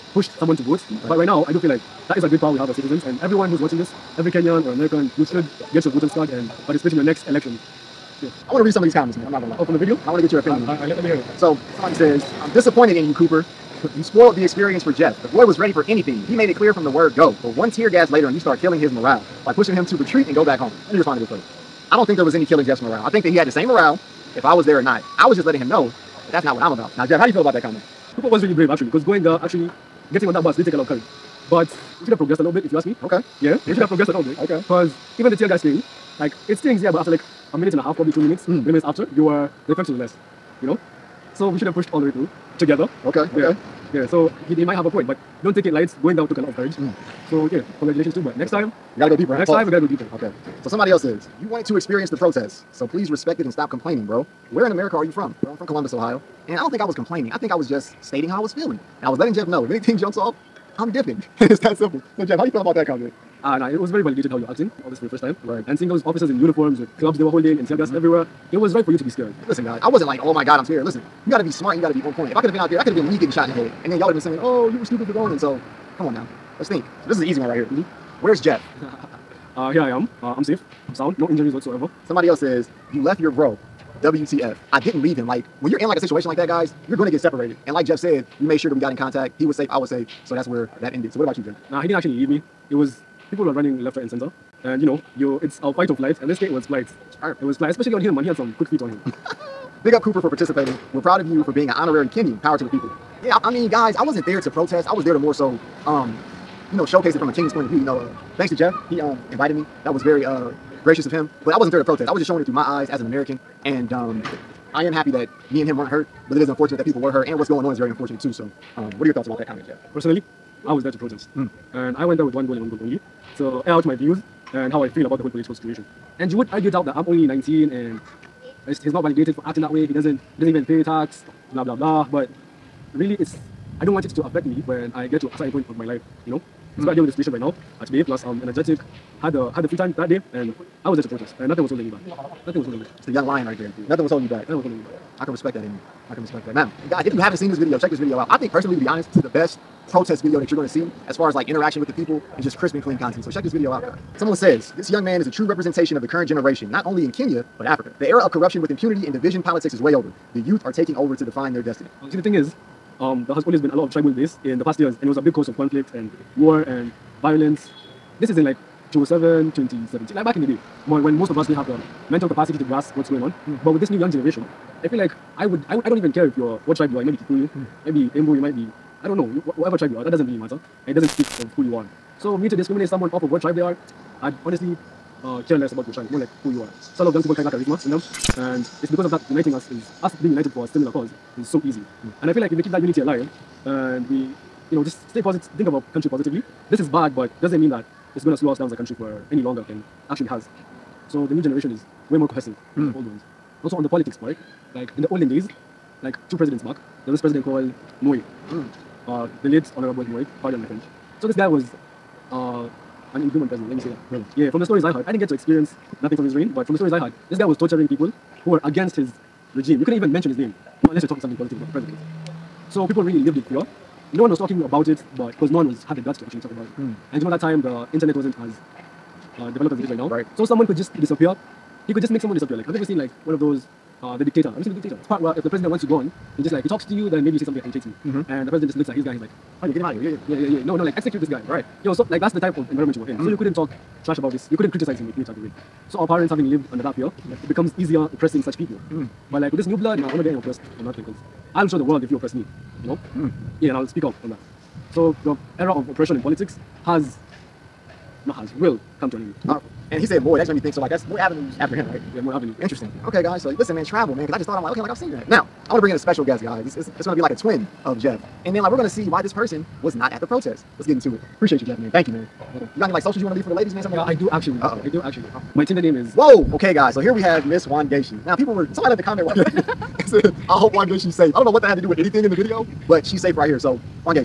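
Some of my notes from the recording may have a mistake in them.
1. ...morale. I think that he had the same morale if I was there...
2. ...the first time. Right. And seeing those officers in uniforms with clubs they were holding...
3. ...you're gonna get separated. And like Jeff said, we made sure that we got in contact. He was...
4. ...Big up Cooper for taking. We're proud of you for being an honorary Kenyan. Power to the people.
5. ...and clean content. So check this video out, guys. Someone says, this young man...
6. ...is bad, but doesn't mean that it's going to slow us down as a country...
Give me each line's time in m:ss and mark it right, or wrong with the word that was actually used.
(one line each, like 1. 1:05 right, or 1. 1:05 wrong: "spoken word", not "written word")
1. 0:22 right
2. 1:05 right
3. 1:26 right
4. 1:39 wrong: "participating", not "taking"
5. 2:32 right
6. 3:16 right.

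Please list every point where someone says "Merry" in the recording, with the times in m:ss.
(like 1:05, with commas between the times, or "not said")
not said.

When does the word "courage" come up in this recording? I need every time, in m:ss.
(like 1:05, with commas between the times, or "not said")
0:30, 0:46.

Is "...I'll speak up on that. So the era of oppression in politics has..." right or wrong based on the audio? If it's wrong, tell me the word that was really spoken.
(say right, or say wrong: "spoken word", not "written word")
right.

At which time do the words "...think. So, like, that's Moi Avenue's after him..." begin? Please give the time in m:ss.
4:20.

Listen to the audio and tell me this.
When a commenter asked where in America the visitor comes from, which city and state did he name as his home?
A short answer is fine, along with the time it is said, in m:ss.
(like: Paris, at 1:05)
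Columbus, Ohio, at 0:55.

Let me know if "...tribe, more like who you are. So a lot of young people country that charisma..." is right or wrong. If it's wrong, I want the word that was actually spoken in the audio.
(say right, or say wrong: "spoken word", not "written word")
wrong: "carry", not "country".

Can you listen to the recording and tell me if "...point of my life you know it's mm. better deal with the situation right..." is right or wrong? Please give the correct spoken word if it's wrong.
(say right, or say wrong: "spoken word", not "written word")
right.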